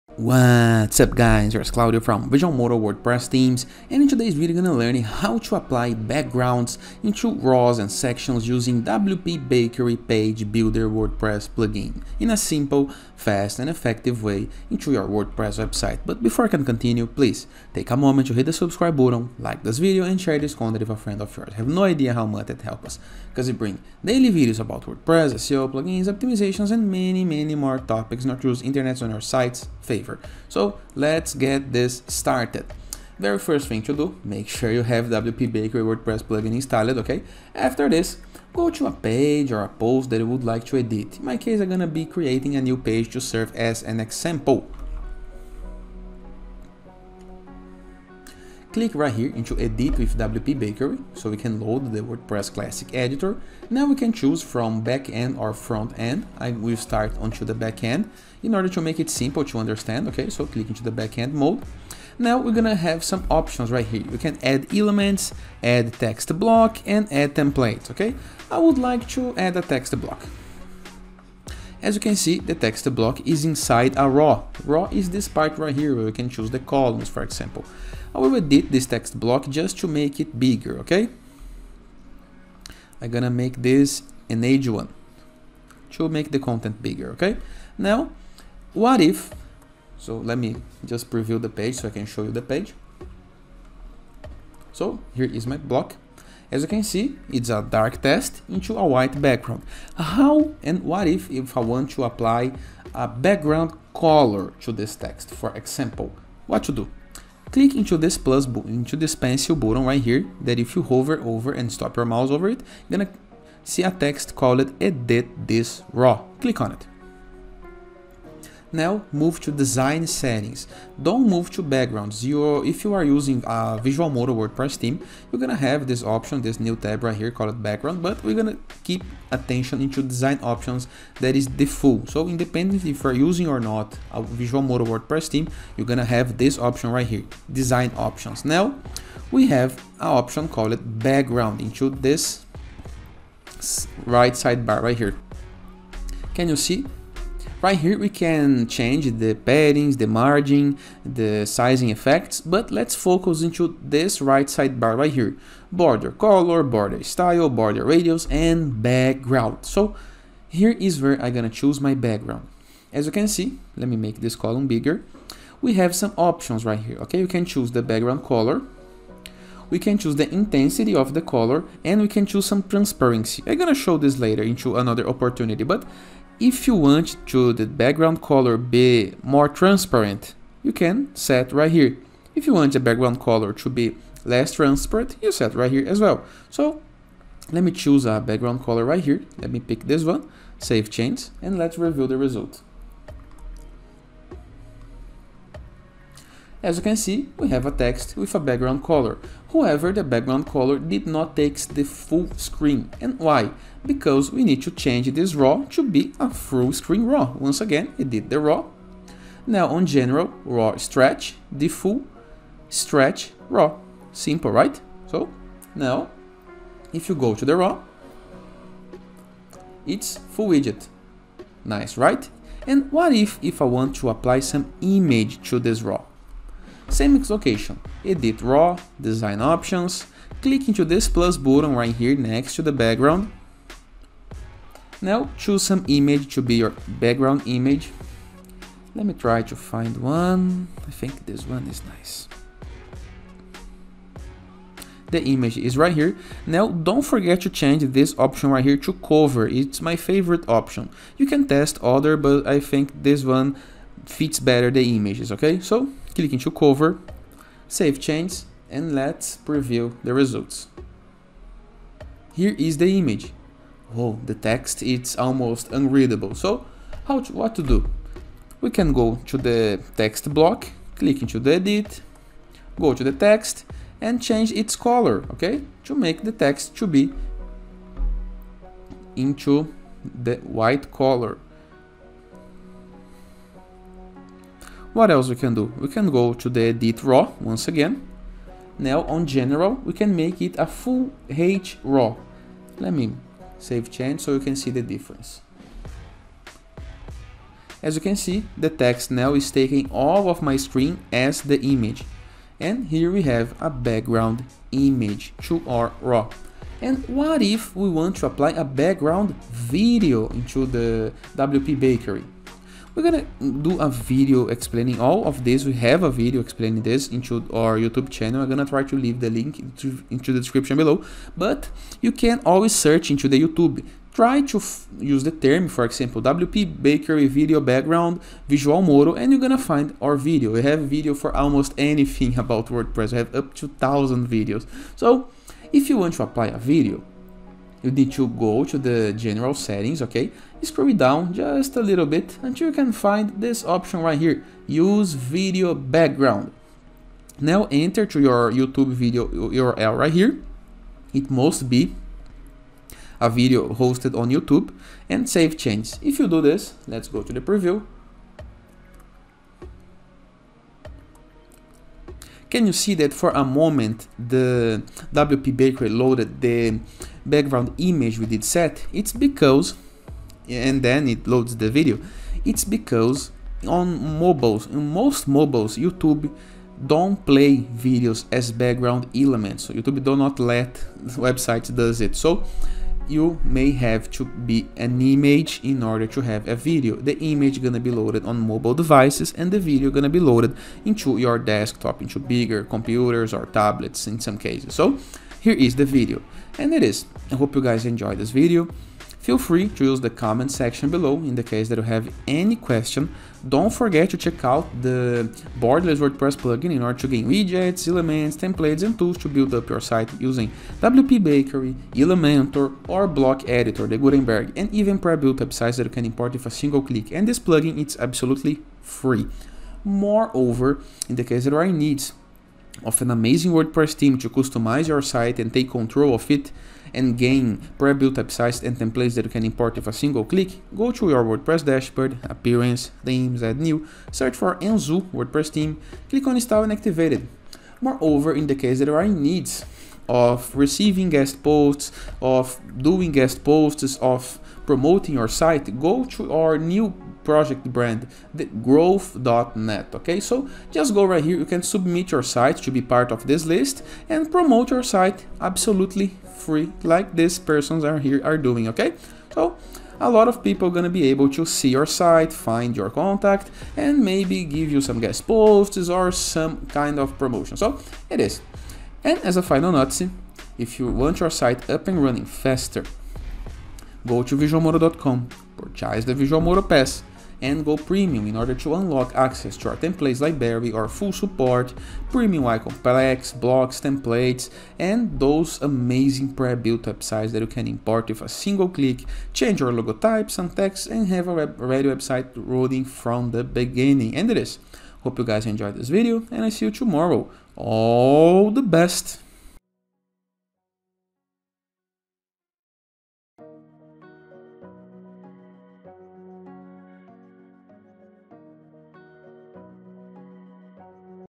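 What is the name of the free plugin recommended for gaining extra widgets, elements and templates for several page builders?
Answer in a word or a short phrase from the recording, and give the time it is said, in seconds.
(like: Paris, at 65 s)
Borderless, at 405 s.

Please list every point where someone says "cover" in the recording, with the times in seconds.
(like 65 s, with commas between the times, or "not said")
248 s, 256 s.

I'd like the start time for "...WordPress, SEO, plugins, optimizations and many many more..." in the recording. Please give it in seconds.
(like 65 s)
24 s.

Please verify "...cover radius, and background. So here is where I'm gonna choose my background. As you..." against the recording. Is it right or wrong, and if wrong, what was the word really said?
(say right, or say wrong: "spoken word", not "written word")
wrong: "border", not "cover".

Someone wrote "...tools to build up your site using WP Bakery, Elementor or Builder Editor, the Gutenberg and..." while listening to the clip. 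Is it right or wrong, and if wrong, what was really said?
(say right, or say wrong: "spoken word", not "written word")
wrong: "Block", not "Builder".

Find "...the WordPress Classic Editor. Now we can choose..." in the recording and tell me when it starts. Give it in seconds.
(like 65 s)
51 s.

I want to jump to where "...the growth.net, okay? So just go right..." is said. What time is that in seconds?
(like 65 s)
448 s.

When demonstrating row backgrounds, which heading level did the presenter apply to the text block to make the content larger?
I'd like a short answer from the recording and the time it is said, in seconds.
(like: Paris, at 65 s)
H1, at 84 s.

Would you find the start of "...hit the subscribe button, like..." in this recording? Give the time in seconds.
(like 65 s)
18 s.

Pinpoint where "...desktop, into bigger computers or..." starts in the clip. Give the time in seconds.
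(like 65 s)
391 s.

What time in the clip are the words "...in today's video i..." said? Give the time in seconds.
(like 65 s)
4 s.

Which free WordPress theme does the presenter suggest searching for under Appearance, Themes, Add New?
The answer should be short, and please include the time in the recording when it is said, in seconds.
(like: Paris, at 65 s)
Enzu, at 434 s.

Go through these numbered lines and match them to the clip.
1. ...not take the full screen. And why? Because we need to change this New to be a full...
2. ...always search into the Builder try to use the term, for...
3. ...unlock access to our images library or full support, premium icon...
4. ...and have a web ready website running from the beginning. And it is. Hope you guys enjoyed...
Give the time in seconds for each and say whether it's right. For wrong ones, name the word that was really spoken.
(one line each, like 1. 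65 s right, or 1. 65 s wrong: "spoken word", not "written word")
1. 201 s wrong: "RAW", not "New"
2. 322 s wrong: "YouTube", not "Builder"
3. 478 s wrong: "templates", not "images"
4. 490 s right.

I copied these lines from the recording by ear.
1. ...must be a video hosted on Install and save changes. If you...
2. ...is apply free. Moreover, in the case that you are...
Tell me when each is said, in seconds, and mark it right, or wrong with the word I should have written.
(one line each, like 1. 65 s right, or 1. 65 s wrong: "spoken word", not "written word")
1. 351 s wrong: "YouTube", not "Install"
2. 417 s wrong: "absolutely", not "apply".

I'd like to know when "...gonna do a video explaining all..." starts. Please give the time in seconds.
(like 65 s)
313 s.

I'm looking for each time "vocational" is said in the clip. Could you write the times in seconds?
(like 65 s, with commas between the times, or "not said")
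not said.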